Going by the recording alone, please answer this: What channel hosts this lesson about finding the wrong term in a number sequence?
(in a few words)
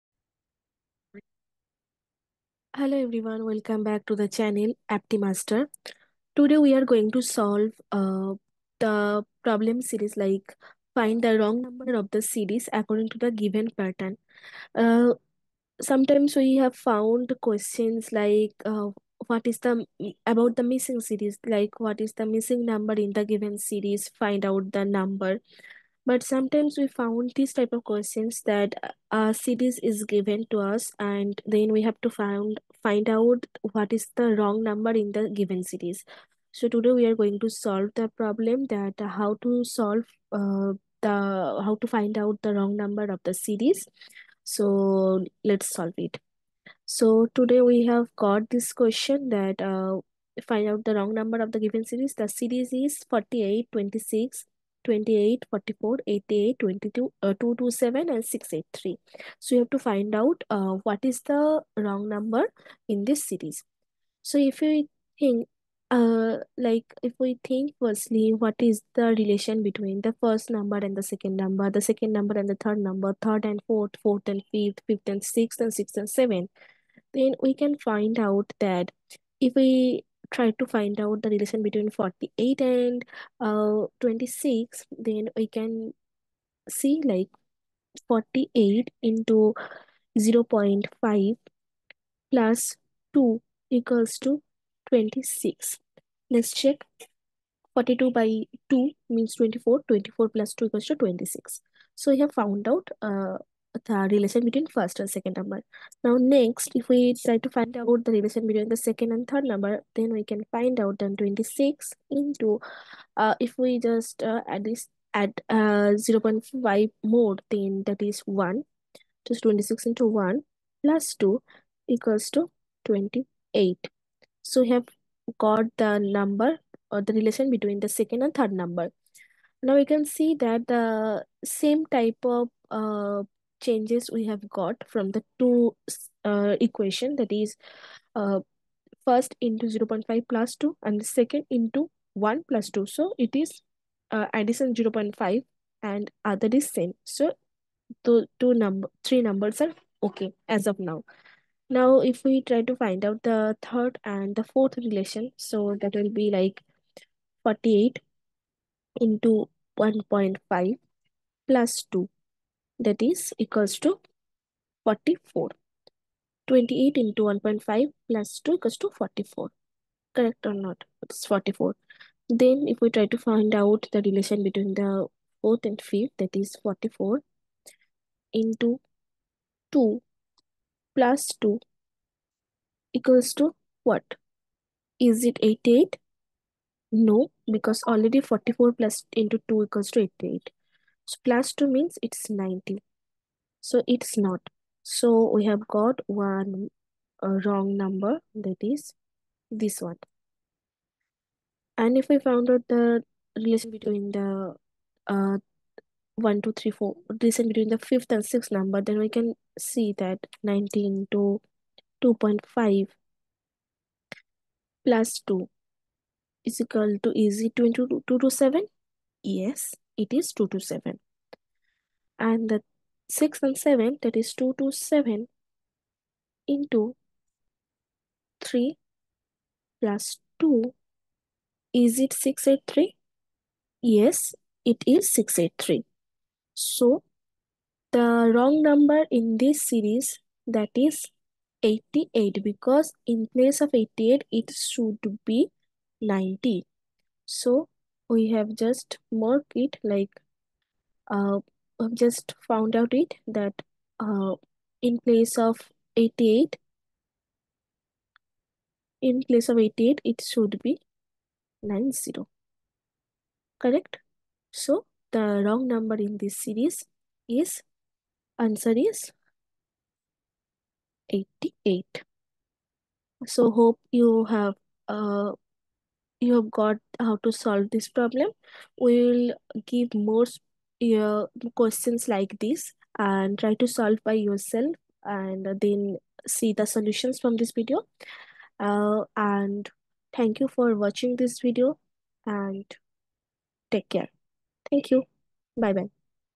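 AptiMaster.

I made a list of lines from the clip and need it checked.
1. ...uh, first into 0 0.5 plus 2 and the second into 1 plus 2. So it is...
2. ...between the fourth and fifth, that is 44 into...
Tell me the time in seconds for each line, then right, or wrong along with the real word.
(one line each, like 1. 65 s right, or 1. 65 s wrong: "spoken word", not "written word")
1. 138 s right
2. 174 s right.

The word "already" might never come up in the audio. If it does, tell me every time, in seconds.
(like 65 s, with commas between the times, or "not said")
187 s.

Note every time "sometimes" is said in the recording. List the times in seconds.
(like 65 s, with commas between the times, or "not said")
15 s, 26 s.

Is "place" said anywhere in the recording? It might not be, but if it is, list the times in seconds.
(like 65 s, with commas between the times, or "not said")
243 s, 254 s, 259 s.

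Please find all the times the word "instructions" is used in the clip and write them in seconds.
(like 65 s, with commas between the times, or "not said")
not said.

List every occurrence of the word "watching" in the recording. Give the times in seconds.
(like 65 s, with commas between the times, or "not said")
290 s.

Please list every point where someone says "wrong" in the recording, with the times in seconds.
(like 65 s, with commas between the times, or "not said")
11 s, 34 s, 42 s, 50 s, 61 s, 197 s, 238 s, 265 s.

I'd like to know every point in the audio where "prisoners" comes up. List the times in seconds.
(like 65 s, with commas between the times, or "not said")
not said.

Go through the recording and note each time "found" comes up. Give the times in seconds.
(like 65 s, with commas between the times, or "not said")
16 s, 26 s, 102 s, 202 s, 252 s.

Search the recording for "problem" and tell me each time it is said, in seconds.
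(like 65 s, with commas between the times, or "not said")
9 s, 38 s, 277 s.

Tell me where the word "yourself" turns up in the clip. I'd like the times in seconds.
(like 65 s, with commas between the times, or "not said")
284 s.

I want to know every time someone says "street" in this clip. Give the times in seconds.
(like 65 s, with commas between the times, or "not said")
not said.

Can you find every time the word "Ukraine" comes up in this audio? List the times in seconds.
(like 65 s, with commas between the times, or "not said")
not said.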